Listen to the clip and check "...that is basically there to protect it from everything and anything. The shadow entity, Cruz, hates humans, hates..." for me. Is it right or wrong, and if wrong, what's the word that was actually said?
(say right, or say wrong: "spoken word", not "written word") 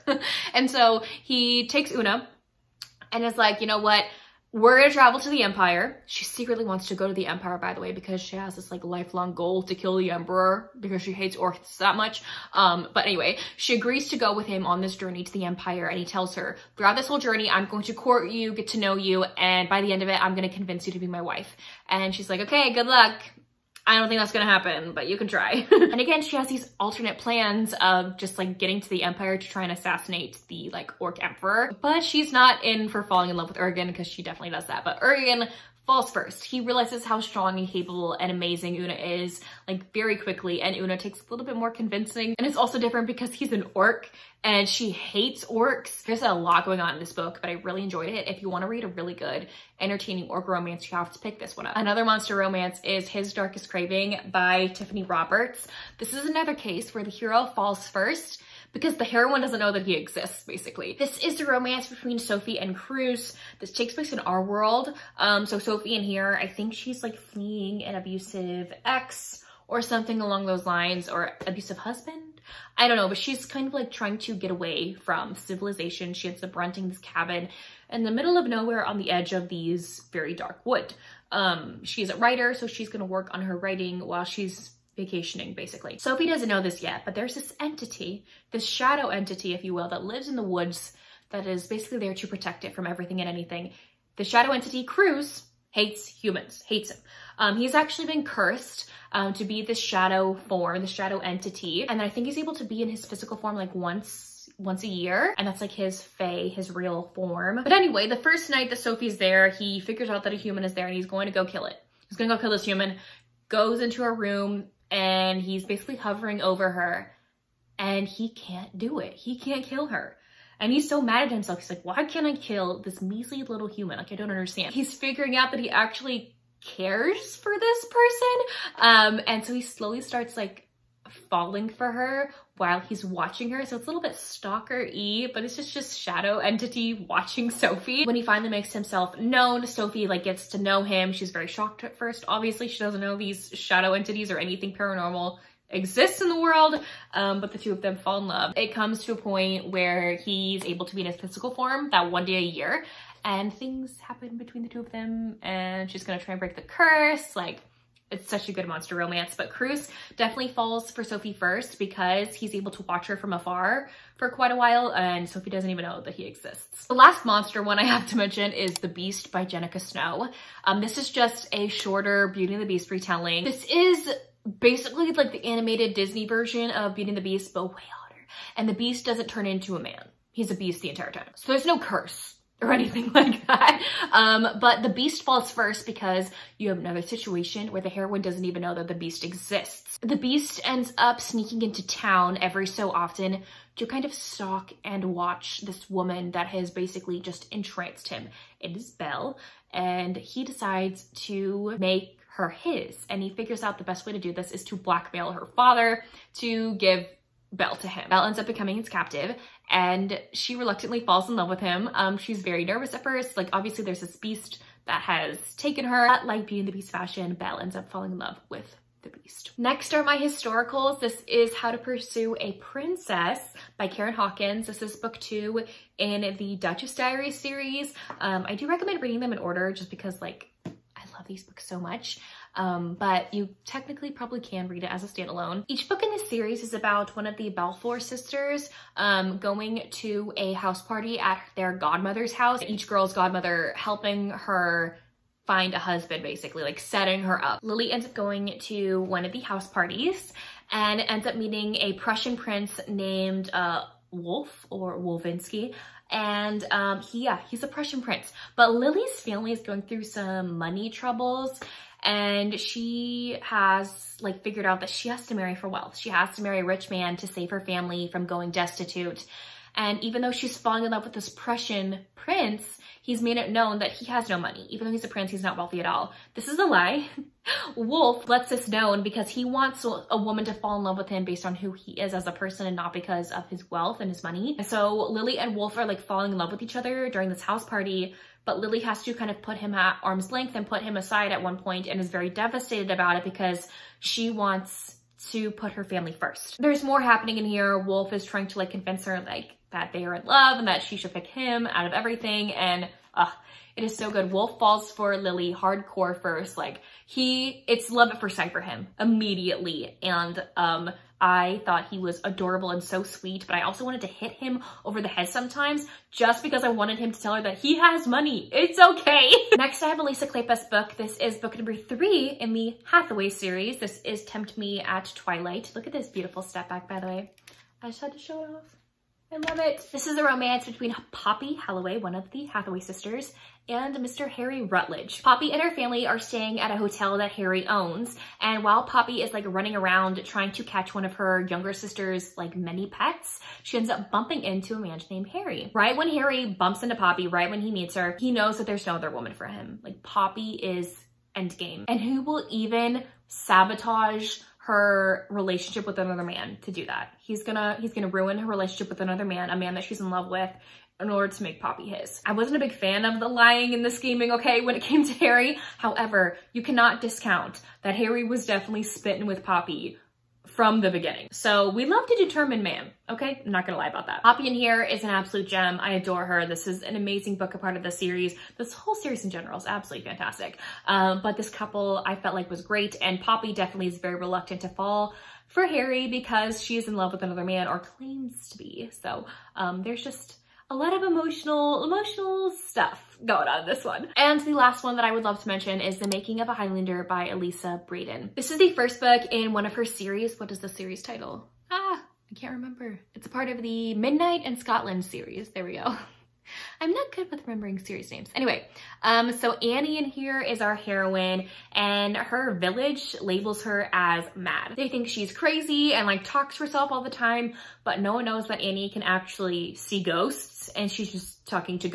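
right.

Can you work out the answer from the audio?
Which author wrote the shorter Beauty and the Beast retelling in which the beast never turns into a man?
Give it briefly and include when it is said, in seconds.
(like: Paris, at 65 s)
Jenika Snow, at 169 s.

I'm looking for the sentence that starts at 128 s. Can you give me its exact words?
Um, and so he slowly starts like falling for her while he's watching her.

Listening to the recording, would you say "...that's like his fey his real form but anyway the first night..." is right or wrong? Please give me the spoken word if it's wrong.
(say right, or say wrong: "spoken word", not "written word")
right.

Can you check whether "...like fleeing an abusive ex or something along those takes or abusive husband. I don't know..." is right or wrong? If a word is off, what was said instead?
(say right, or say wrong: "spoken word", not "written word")
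wrong: "lines", not "takes".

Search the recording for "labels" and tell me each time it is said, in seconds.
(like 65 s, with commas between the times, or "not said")
413 s.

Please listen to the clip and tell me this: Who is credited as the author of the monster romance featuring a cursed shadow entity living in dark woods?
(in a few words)
Tiffany Roberts.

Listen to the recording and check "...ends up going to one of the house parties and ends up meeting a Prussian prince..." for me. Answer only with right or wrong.
right.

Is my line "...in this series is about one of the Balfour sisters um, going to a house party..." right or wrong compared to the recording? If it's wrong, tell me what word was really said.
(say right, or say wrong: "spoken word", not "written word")
right.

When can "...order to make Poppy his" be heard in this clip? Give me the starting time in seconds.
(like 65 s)
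361 s.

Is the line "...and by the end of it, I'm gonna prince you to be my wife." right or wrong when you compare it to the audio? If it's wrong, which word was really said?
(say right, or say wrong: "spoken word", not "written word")
wrong: "convince", not "prince".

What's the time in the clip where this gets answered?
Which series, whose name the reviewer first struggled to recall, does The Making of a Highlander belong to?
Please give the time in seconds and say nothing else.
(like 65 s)
403 s.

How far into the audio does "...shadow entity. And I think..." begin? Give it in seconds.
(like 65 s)
100 s.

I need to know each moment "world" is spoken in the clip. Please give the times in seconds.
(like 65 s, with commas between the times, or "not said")
64 s, 146 s.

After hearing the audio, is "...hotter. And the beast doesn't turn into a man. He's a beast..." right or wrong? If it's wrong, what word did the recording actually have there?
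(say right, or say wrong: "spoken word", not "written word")
right.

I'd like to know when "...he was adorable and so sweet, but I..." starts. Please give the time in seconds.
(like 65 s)
311 s.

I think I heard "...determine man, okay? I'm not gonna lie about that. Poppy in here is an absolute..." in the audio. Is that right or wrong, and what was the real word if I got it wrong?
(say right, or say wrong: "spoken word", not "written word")
right.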